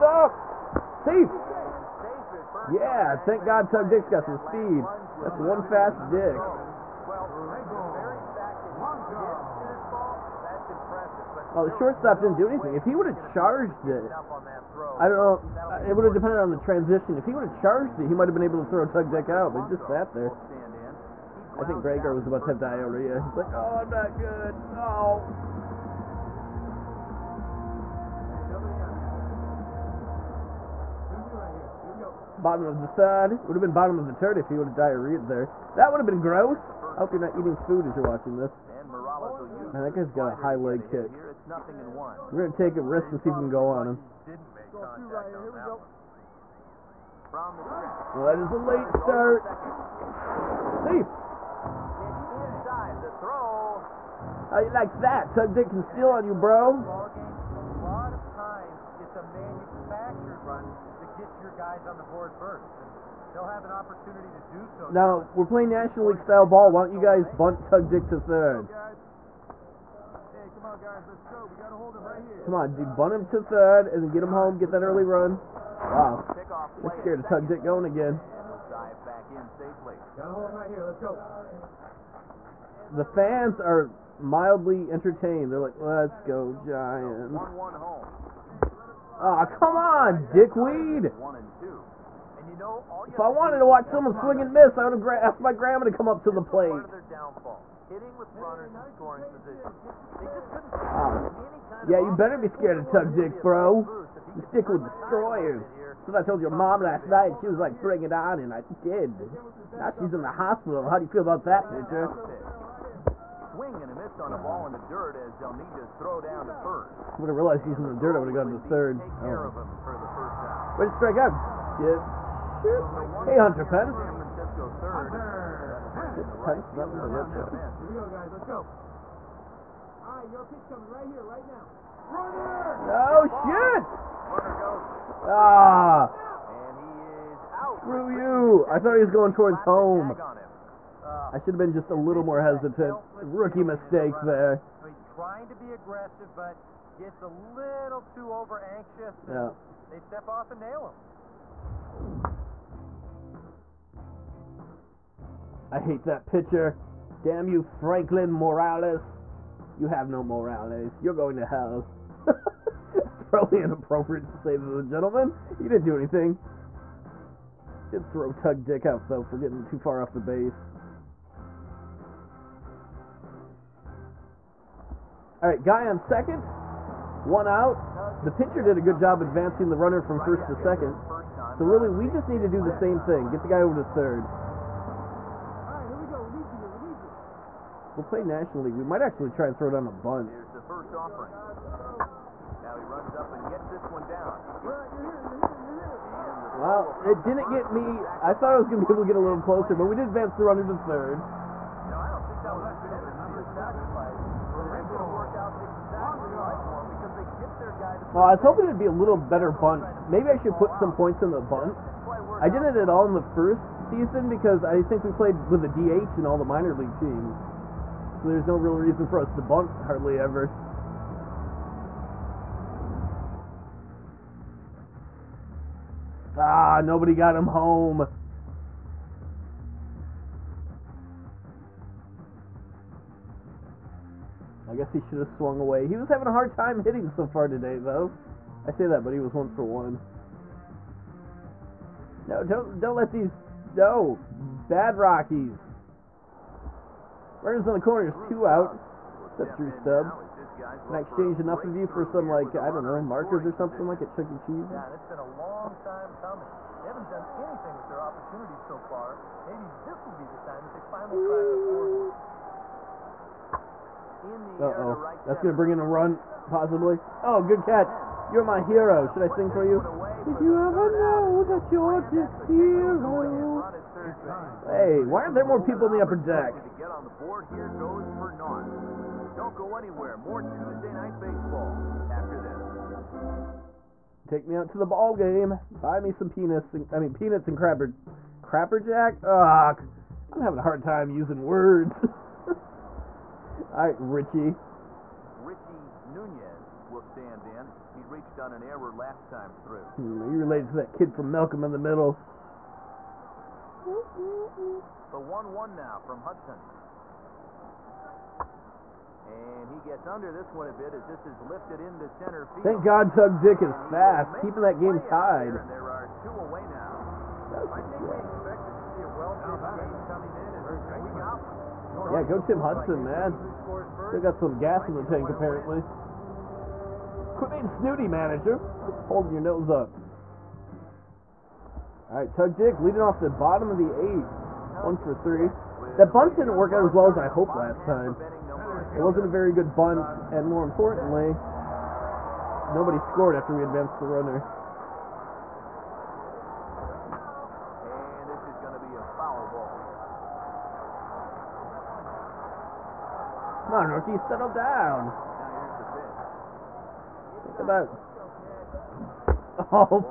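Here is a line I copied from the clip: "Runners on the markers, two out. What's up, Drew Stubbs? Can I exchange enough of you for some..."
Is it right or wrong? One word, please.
wrong.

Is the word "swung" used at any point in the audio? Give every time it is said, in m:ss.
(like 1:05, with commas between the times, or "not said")
3:55.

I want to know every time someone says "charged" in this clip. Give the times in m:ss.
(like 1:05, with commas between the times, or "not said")
0:13, 0:17.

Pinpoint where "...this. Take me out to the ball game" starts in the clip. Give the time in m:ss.
4:42.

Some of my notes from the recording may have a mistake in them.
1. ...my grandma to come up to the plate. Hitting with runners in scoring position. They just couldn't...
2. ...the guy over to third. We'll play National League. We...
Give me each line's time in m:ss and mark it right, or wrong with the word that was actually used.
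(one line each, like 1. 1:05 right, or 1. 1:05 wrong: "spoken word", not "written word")
1. 1:35 right
2. 3:03 right.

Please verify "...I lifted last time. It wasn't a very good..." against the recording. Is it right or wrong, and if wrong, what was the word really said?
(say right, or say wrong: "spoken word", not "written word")
wrong: "hoped", not "lifted".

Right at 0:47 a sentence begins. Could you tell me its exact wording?
Well, that is a late start.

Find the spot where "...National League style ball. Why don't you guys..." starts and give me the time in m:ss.
1:05.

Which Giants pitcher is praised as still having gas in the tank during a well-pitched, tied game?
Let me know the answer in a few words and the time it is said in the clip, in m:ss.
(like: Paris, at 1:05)
Tim Hudson, at 5:22.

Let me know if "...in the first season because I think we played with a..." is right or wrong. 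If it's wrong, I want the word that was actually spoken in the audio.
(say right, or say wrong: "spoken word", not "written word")
right.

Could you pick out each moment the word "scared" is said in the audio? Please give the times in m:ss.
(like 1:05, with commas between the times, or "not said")
1:16, 1:42.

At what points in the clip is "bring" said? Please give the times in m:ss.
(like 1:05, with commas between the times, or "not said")
1:47, 4:25.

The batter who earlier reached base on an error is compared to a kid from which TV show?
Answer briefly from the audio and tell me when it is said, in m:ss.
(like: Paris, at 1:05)
Malcolm in the Middle, at 5:01.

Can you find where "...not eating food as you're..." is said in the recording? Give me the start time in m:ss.
0:37.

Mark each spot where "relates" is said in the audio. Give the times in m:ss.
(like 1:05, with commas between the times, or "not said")
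5:00.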